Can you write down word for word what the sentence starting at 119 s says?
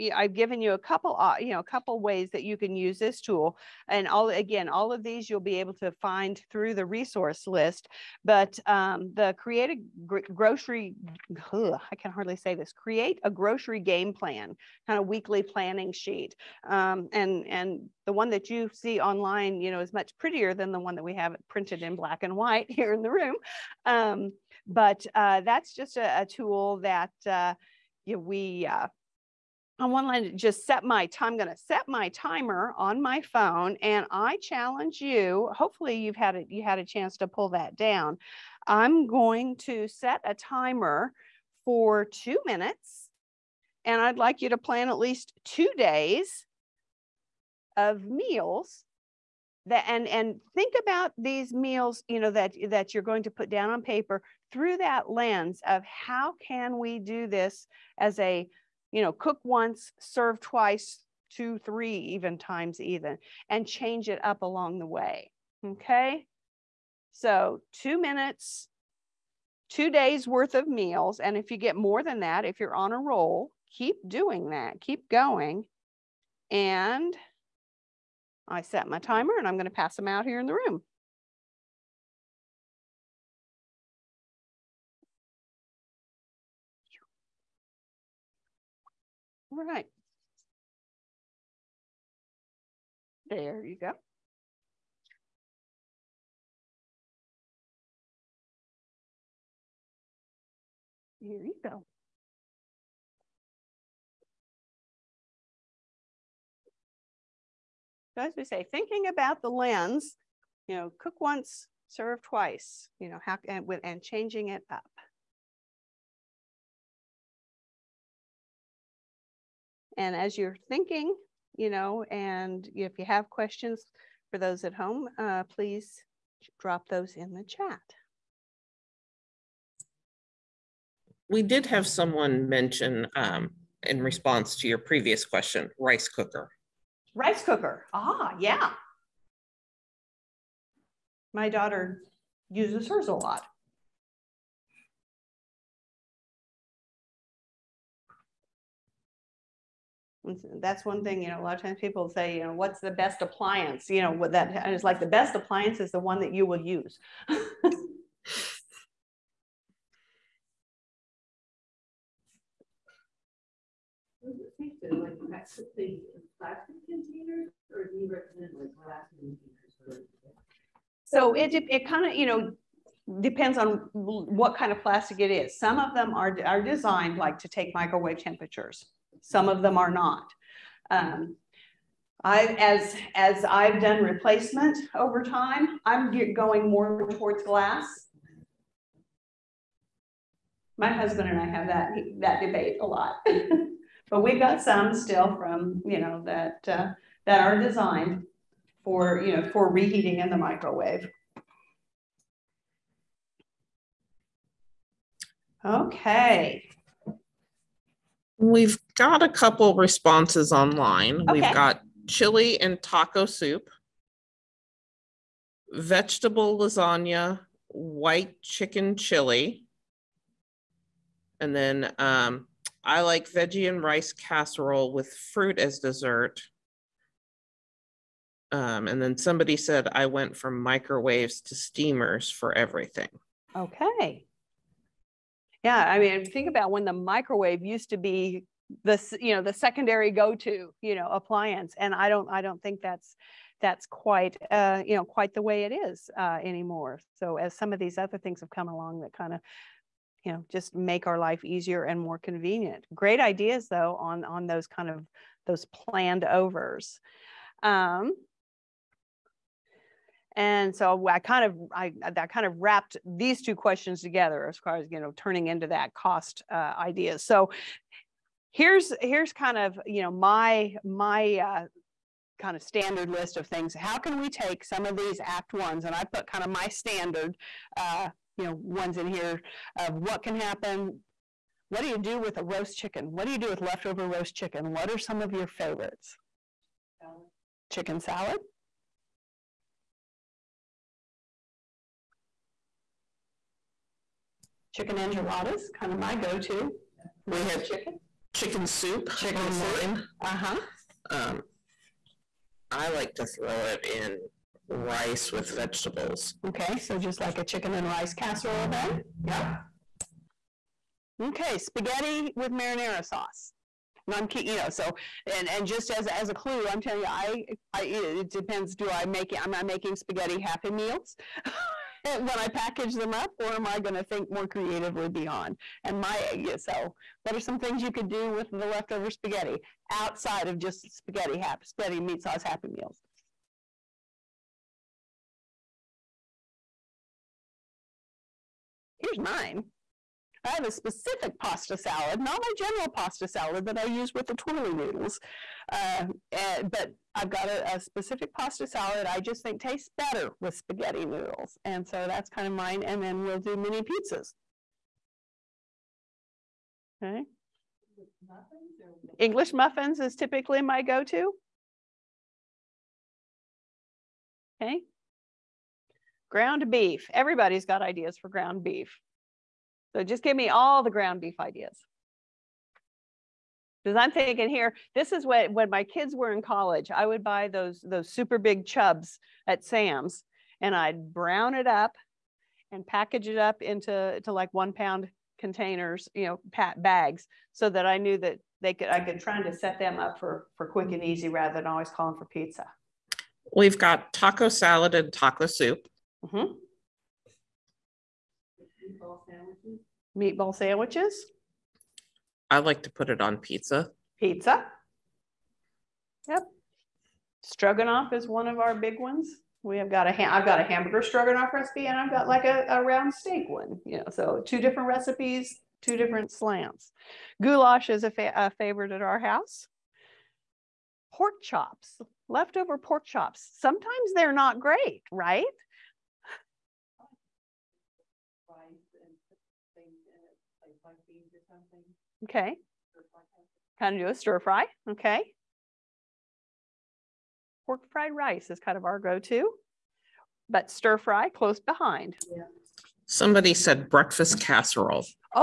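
And as you're thinking, you know, and if you have questions for those at home, uh, please drop those in the chat.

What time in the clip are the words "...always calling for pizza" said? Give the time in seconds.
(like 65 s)
391 s.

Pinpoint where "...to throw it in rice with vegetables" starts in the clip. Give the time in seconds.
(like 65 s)
303 s.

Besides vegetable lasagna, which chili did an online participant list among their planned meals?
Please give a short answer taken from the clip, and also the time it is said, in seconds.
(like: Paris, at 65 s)
White chicken chili, at 217 s.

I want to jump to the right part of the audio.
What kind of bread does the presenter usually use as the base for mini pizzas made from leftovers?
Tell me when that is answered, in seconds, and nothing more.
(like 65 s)
359 s.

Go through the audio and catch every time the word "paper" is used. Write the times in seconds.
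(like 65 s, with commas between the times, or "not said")
53 s.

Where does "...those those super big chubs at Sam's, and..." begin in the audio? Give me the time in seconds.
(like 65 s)
377 s.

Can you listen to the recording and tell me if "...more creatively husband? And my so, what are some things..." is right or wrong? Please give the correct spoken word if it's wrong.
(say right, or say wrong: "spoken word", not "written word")
wrong: "beyond", not "husband".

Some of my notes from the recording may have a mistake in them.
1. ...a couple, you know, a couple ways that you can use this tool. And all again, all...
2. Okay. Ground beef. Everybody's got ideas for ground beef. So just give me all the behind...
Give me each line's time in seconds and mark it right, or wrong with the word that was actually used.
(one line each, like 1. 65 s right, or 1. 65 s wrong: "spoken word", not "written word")
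1. 0 s right
2. 364 s wrong: "ground", not "behind".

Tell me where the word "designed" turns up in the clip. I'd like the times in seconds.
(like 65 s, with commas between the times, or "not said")
176 s, 197 s.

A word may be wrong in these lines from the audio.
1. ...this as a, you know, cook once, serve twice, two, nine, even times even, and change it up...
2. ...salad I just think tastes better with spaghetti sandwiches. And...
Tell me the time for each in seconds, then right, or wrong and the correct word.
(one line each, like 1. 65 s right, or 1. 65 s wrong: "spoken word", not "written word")
1. 57 s wrong: "three", not "nine"
2. 348 s wrong: "noodles", not "sandwiches".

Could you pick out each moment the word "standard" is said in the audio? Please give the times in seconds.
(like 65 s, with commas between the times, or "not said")
272 s, 276 s.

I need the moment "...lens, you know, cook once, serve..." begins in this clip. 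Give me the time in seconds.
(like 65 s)
109 s.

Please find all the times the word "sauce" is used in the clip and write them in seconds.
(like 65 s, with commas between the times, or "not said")
313 s, 332 s.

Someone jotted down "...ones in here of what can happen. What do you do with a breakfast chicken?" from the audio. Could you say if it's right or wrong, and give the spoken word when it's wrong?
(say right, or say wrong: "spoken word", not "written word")
wrong: "roast", not "breakfast".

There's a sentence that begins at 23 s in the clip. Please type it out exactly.
Um, but uh, that's just a, a tool that.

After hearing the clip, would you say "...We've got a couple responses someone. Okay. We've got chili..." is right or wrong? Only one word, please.
wrong.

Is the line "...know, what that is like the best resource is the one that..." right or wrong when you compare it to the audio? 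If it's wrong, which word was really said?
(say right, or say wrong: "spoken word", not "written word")
wrong: "appliance", not "resource".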